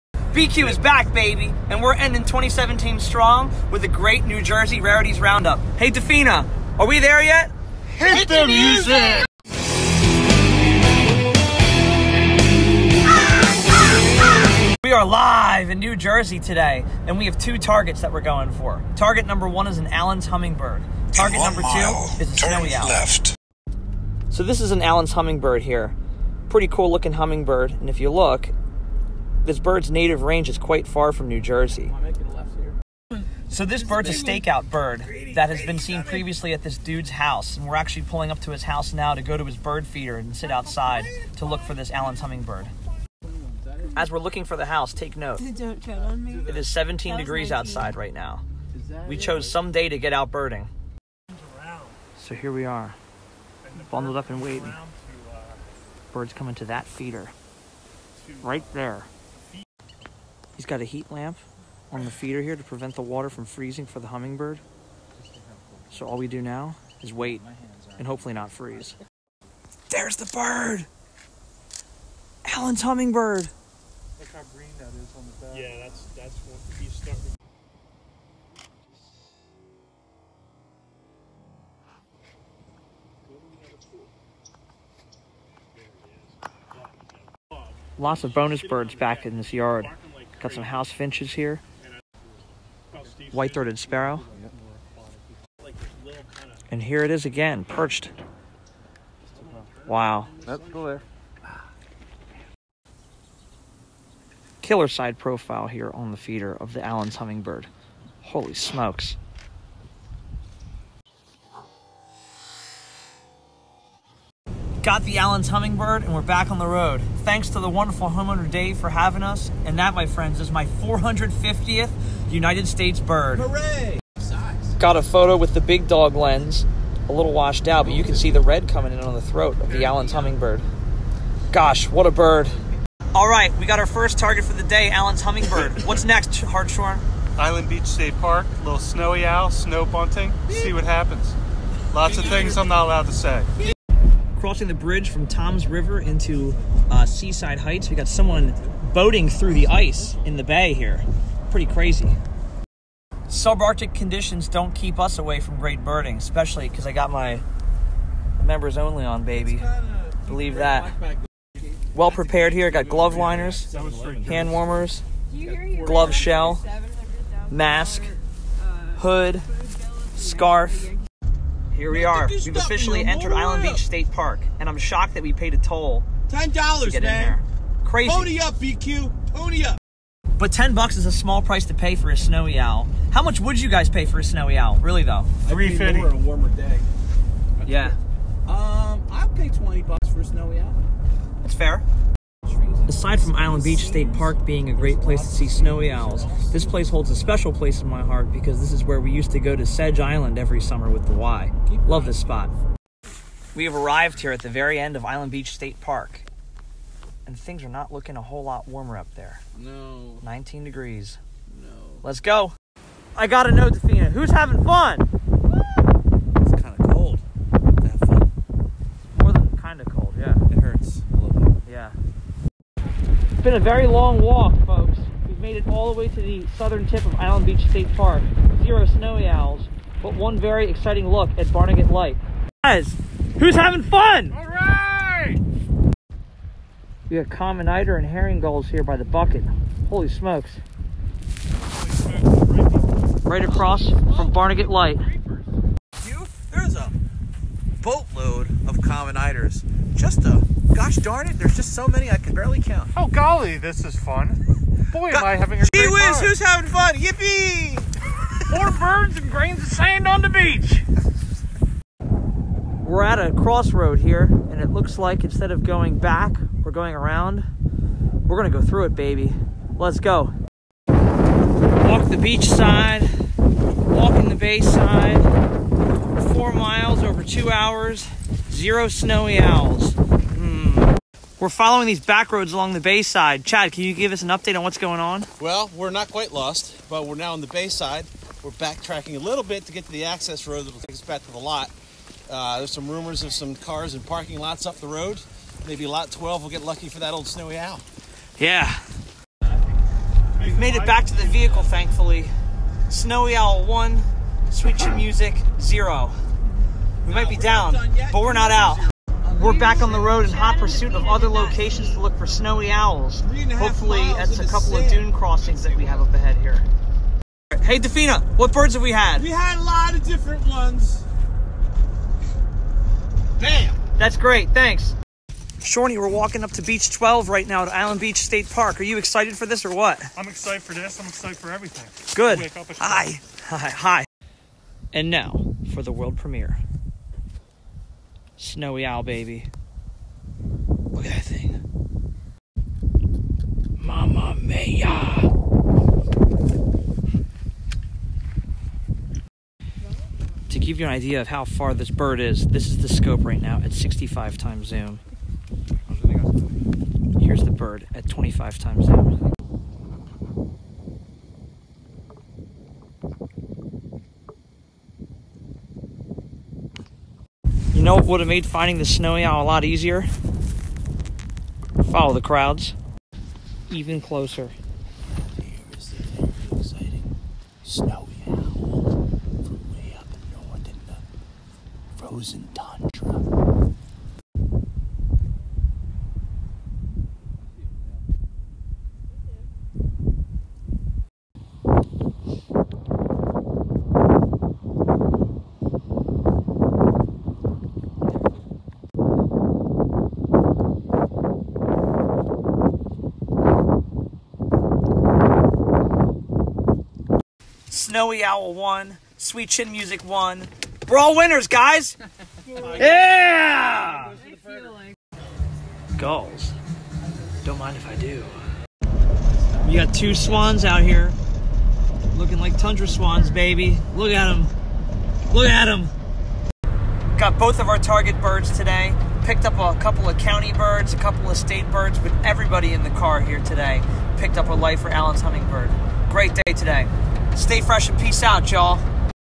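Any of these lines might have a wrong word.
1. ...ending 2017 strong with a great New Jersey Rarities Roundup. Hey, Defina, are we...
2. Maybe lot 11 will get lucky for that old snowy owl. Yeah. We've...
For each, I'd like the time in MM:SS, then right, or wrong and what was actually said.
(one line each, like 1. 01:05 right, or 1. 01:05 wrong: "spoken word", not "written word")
1. 00:01 right
2. 04:55 wrong: "12", not "11".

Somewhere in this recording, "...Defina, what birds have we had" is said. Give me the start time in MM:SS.
05:17.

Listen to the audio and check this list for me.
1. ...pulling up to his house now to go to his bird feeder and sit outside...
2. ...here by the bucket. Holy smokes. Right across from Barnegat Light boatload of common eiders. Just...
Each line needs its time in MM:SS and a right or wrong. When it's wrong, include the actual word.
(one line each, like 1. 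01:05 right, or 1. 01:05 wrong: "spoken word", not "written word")
1. 00:38 right
2. 03:58 right.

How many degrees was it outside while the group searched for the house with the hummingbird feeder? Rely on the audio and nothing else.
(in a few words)
17.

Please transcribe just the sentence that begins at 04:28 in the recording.
We're gonna go through it, baby.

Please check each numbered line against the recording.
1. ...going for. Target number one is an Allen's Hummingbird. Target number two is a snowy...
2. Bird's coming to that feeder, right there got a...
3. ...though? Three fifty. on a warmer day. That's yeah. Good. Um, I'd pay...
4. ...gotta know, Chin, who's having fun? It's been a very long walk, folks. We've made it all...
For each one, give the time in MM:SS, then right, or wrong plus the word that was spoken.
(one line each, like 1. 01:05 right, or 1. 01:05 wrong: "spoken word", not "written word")
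1. 00:18 right
2. 00:56 right
3. 03:05 right
4. 03:33 wrong: "Defina", not "Chin".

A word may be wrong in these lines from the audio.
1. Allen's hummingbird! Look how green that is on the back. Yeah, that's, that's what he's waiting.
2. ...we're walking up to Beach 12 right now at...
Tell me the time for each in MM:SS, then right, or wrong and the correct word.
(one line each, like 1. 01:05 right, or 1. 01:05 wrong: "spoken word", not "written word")
1. 01:12 wrong: "starting", not "waiting"
2. 05:25 right.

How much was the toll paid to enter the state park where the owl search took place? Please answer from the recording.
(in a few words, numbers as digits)
$10.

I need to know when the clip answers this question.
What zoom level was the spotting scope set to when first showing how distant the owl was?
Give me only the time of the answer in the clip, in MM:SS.
05:53.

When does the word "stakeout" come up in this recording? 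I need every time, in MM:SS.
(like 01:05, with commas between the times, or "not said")
00:34.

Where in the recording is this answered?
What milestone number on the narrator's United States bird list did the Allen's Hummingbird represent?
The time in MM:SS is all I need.
02:00.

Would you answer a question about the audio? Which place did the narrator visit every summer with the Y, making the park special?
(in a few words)
Sedge Island.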